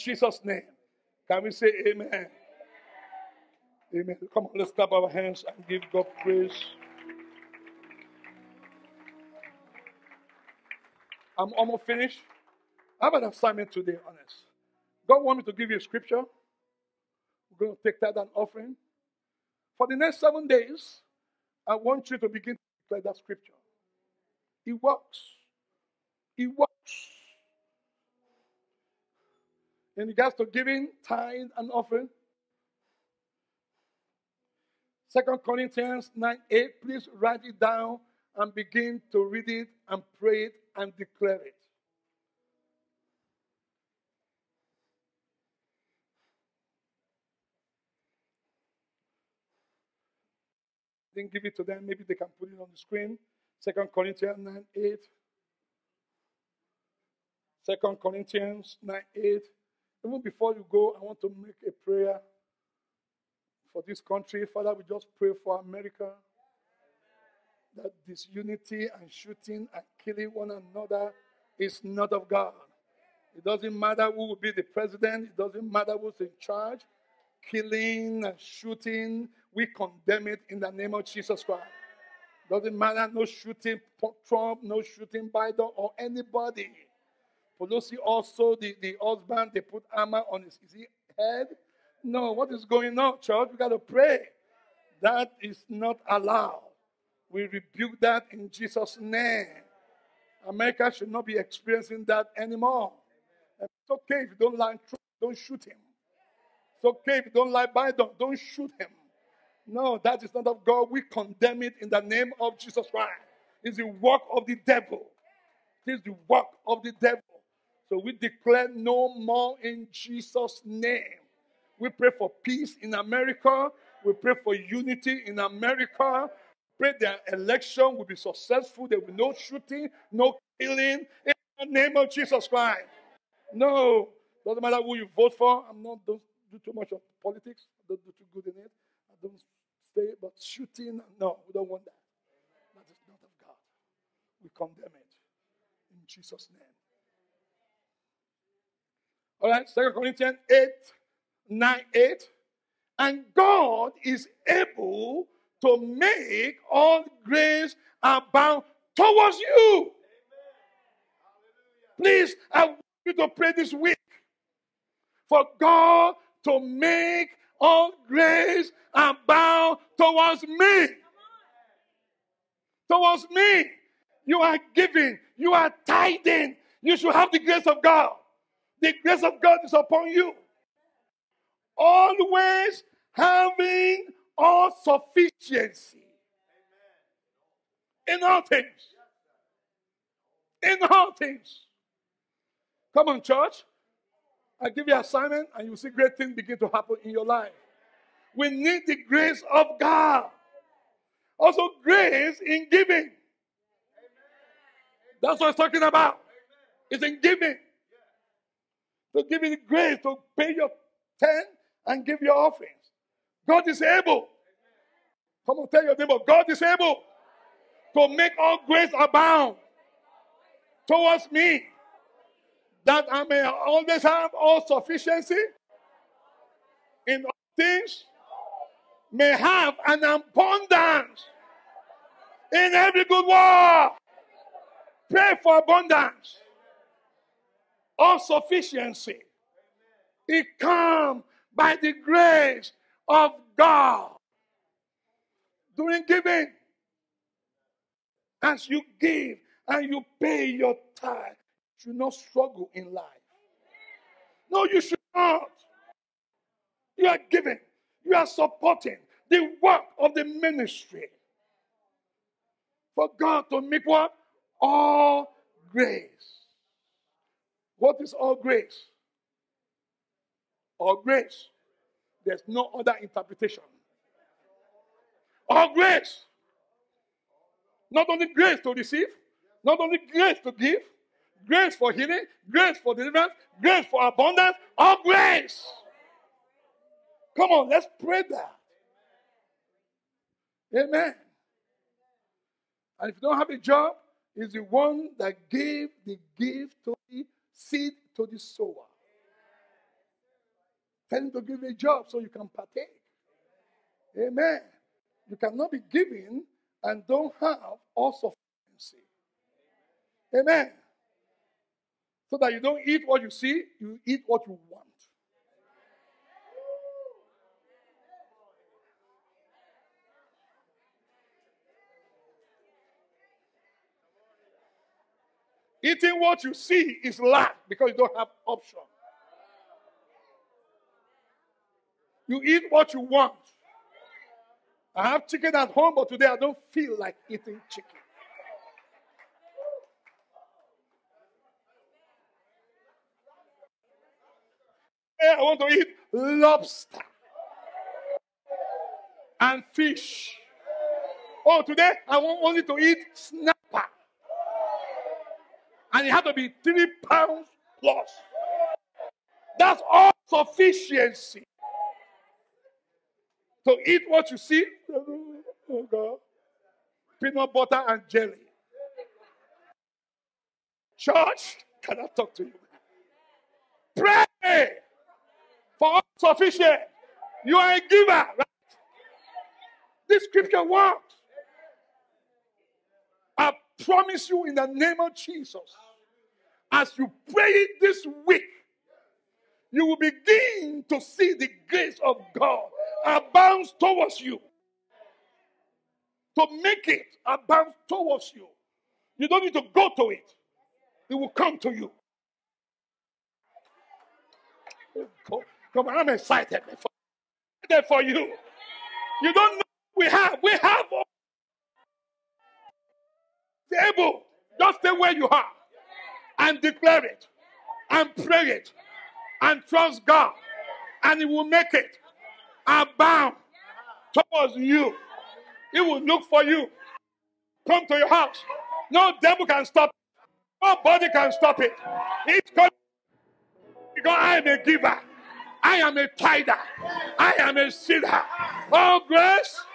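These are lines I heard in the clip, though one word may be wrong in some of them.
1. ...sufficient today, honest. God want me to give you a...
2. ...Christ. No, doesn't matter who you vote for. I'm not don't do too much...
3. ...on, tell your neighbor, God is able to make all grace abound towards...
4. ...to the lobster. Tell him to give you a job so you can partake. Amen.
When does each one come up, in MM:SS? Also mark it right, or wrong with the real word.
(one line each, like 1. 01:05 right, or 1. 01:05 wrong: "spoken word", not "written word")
1. 00:13 wrong: "assignment", not "sufficient"
2. 02:12 right
3. 03:35 right
4. 04:58 wrong: "sower", not "lobster".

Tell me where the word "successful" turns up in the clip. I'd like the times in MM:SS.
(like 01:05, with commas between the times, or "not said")
02:08.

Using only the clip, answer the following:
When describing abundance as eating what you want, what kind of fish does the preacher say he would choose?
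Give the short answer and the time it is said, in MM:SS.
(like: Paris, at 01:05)
Snapper, at 05:53.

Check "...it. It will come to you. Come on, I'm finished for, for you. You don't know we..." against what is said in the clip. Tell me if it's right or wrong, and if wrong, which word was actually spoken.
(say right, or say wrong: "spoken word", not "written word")
wrong: "excited", not "finished".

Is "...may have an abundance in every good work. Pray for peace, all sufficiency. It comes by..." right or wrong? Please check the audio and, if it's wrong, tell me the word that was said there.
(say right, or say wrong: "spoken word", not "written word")
wrong: "abundance", not "peace".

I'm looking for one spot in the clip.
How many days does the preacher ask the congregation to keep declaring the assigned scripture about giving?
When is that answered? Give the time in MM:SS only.
00:20.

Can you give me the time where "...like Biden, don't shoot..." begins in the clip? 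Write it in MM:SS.
01:47.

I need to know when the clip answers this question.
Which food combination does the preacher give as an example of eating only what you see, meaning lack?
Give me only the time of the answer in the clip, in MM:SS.
06:07.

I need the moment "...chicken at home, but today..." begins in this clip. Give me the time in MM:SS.
05:35.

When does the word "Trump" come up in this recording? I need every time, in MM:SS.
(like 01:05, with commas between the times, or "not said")
01:24, 01:44.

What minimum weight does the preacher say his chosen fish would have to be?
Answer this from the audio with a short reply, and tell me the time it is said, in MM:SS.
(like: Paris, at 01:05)
3 pounds plus, at 05:56.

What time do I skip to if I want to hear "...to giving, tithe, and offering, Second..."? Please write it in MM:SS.
00:30.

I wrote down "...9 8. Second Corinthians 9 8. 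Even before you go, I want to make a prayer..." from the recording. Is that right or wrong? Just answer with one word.
right.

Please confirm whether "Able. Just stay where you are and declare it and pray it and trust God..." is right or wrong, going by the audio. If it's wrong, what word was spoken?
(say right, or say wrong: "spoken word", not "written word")
right.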